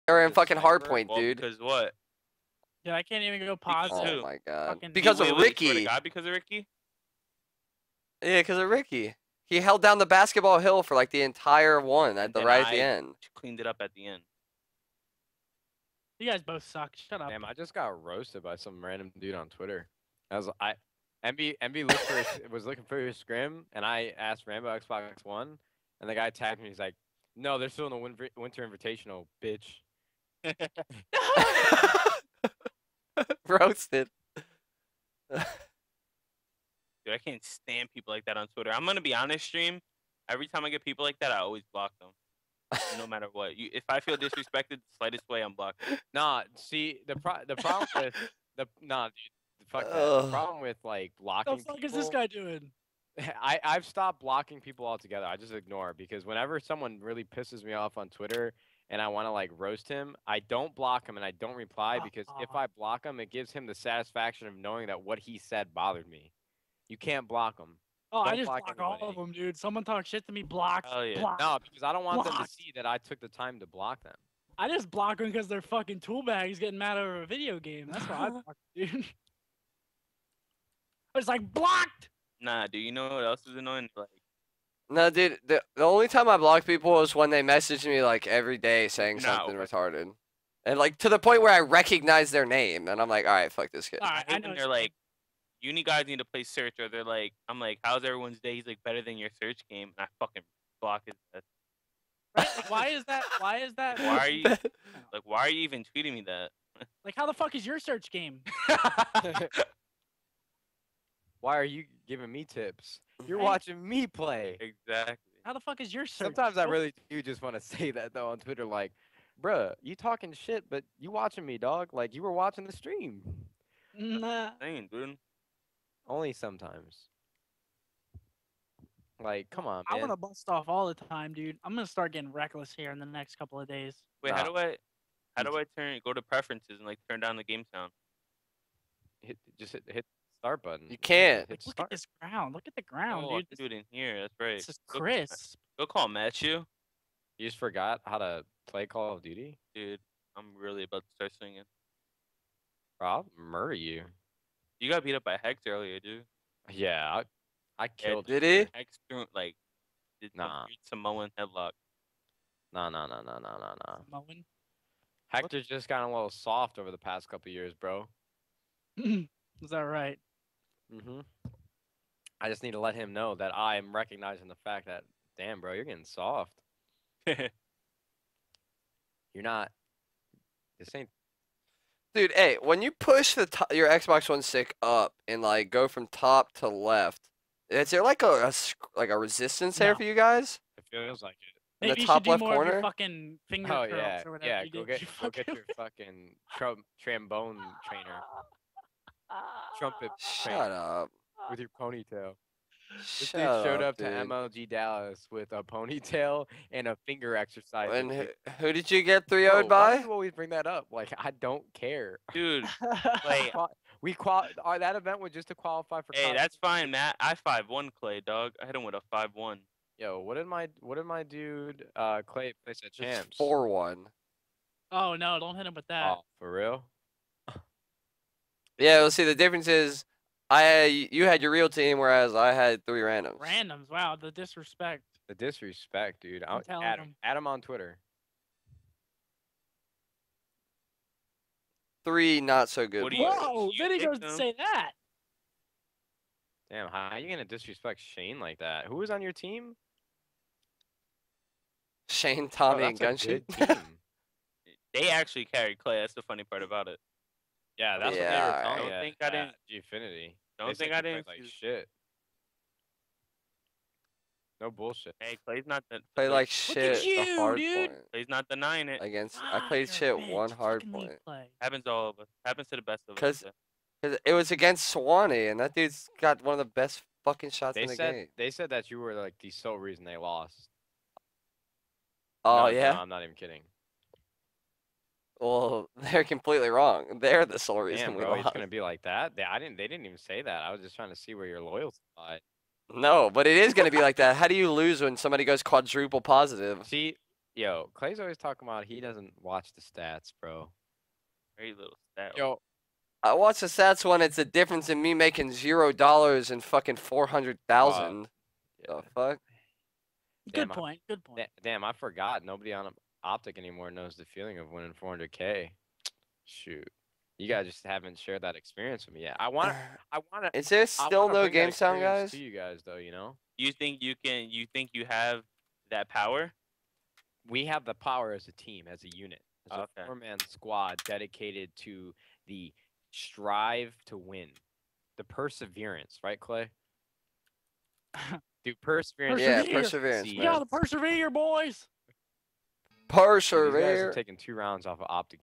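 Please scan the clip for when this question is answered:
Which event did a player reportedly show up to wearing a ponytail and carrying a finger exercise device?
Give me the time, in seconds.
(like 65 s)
204 s.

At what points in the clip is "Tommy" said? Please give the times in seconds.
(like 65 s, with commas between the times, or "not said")
252 s.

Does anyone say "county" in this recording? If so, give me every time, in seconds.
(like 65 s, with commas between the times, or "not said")
not said.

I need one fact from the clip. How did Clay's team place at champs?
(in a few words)
4 1.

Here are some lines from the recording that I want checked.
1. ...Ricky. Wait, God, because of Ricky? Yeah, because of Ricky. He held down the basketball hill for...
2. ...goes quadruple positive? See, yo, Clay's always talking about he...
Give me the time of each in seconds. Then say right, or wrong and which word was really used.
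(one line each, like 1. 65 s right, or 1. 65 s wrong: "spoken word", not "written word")
1. 5 s right
2. 295 s right.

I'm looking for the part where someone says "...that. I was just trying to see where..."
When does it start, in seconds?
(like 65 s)
290 s.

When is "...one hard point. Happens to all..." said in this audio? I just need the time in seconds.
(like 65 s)
270 s.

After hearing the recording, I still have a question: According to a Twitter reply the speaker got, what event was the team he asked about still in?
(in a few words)
Winter Invitational.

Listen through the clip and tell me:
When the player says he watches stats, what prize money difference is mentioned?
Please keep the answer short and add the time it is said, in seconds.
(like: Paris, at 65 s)
400,000 dollars, at 306 s.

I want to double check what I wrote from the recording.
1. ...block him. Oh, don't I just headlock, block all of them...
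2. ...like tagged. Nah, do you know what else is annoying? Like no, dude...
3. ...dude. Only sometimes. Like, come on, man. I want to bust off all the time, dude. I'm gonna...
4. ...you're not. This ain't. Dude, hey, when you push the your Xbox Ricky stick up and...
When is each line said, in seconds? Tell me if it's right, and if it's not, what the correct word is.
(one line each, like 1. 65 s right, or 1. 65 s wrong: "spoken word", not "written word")
1. 67 s wrong: "block", not "headlock"
2. 81 s wrong: "blocked", not "tagged"
3. 124 s right
4. 177 s wrong: "One", not "Ricky".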